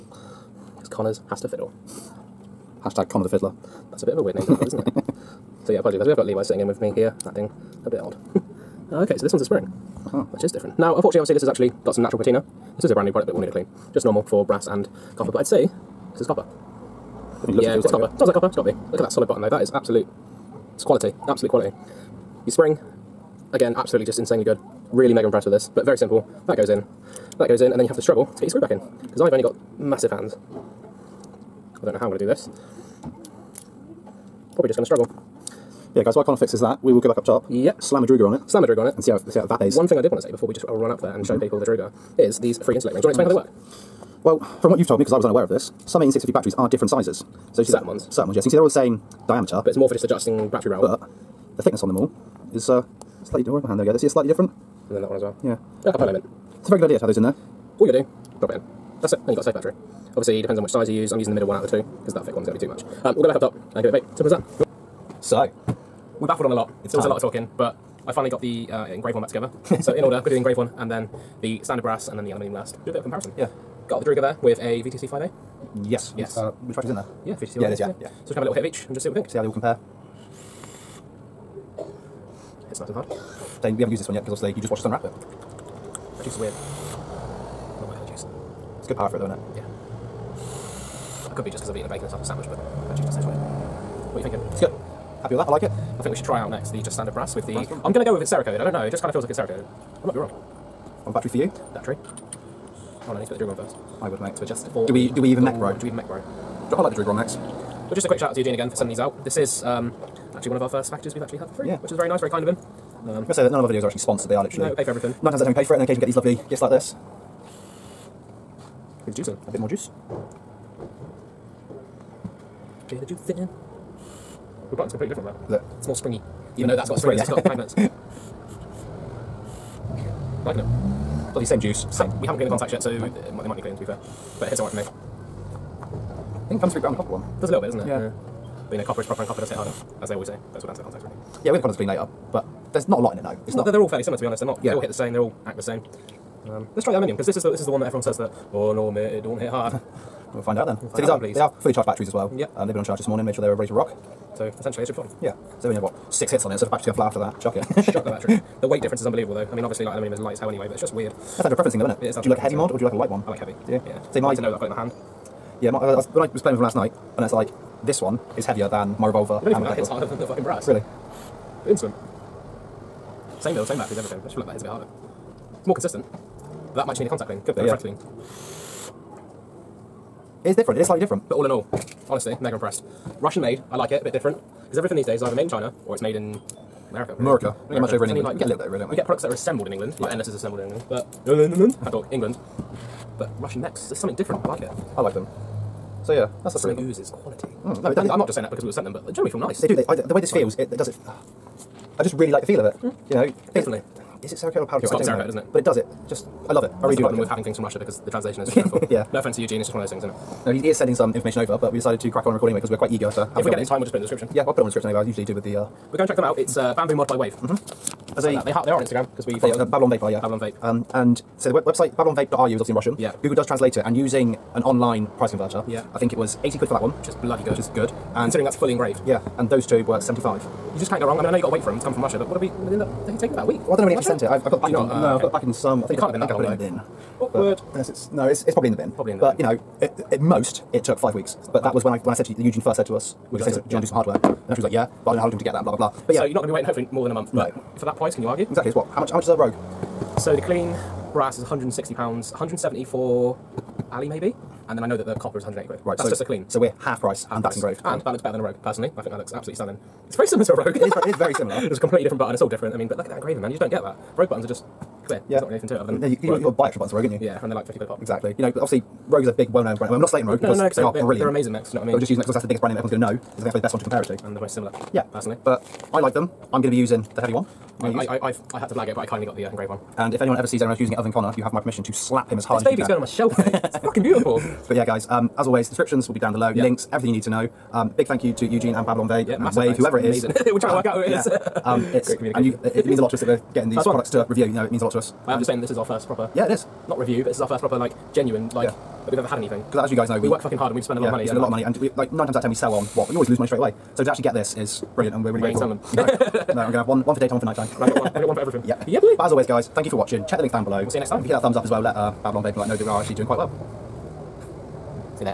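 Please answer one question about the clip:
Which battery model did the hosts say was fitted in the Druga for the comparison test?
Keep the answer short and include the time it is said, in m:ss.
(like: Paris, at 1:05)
VTC 5A, at 1:14.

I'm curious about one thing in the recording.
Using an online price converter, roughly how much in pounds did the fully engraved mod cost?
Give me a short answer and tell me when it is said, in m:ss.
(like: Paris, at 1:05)
80 pounds, at 3:46.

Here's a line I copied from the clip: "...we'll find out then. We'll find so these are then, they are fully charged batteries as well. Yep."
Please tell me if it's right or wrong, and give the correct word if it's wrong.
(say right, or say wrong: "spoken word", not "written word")
right.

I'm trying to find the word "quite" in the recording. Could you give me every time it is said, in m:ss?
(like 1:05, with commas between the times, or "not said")
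3:32, 5:13.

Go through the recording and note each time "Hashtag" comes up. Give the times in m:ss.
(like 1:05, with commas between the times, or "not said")
0:02.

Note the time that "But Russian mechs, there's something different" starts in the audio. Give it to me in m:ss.
3:13.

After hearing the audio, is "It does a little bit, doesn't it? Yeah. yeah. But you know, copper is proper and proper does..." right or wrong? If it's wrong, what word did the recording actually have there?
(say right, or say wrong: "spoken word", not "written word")
wrong: "copper", not "proper".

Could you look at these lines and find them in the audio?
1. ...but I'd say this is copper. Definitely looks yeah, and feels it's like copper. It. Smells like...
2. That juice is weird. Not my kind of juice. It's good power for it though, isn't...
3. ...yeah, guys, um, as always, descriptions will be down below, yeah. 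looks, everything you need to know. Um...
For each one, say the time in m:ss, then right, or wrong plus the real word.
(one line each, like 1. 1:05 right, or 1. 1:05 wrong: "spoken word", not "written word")
1. 0:15 right
2. 1:26 right
3. 4:44 wrong: "links", not "looks".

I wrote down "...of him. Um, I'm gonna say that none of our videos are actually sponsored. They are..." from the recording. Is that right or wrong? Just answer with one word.
right.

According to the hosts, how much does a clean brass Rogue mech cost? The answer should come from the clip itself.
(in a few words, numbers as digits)
160 pounds.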